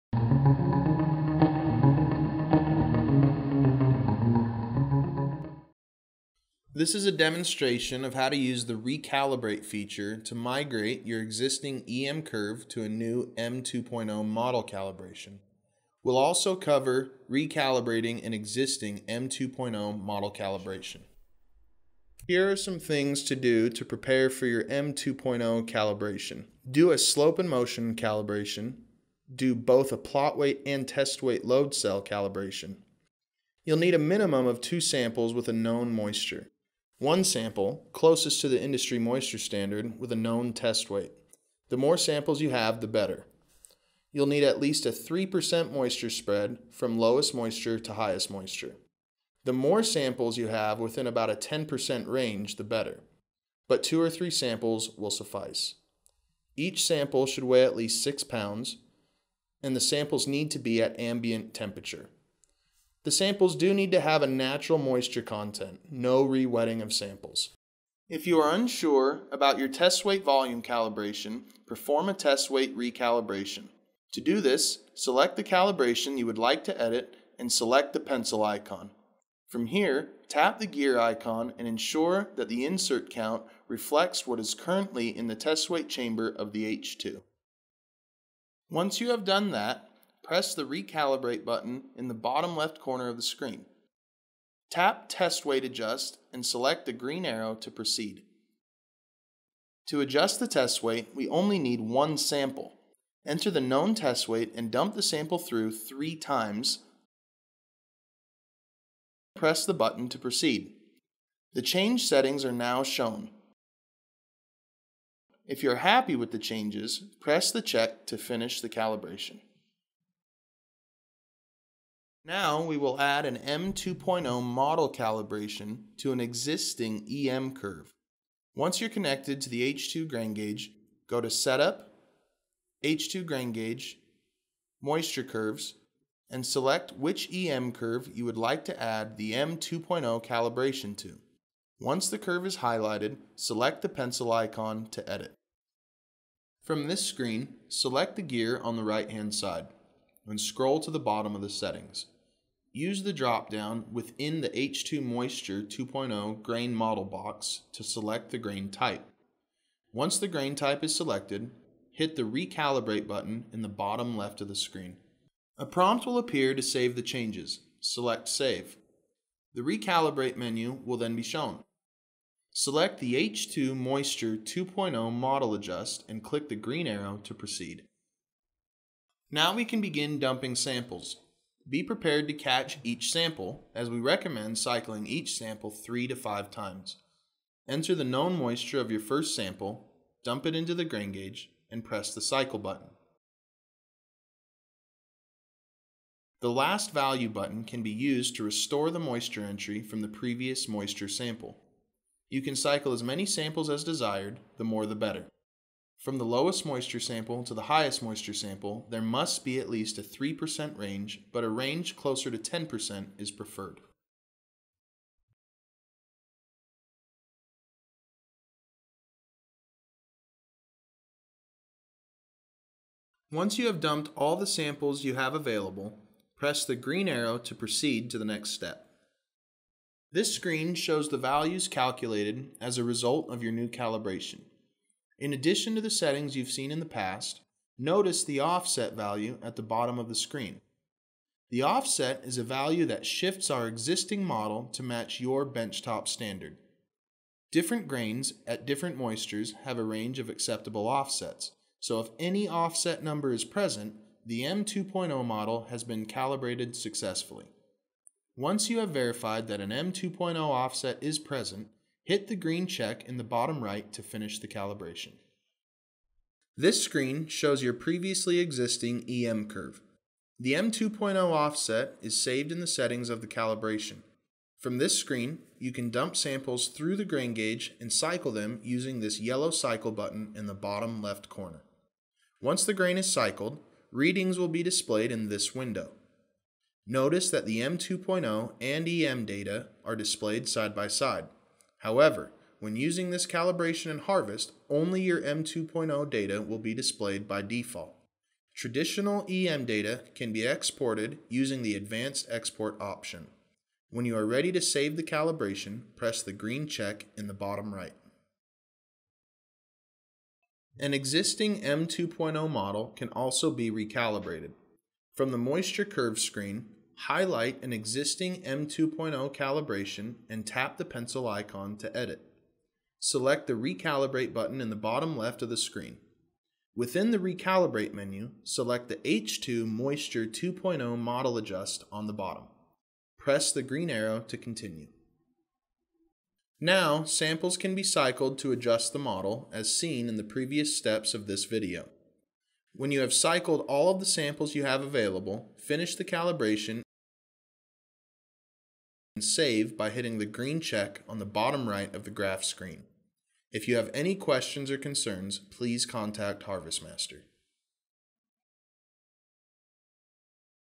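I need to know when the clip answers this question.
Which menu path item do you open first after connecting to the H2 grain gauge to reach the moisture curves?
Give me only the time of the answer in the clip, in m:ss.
2:11.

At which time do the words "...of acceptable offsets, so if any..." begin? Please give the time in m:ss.
4:10.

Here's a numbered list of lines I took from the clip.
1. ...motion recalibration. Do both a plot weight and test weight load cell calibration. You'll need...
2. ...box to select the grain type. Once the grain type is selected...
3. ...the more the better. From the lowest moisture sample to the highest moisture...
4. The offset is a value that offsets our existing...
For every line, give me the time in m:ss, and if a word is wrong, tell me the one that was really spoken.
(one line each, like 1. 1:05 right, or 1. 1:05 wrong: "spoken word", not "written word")
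1. 0:27 wrong: "calibration", not "recalibration"
2. 2:37 right
3. 3:24 right
4. 4:01 wrong: "shifts", not "offsets".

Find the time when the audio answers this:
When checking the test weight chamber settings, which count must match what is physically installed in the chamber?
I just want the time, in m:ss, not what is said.
1:22.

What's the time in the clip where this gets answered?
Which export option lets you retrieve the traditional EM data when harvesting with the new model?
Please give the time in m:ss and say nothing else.
5:01.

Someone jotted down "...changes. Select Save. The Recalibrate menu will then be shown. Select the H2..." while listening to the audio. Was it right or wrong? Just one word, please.
right.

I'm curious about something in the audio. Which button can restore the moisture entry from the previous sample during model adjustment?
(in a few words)
last value button.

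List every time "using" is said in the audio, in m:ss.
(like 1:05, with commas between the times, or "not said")
4:38, 4:52, 5:01.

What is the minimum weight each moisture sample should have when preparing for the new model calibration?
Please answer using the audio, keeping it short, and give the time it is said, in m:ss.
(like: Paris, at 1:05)
6 pounds, at 0:58.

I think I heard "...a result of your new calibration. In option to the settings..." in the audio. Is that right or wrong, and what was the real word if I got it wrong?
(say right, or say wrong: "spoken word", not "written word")
wrong: "addition", not "option".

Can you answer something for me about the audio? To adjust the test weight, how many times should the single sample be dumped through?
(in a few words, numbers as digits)
three times.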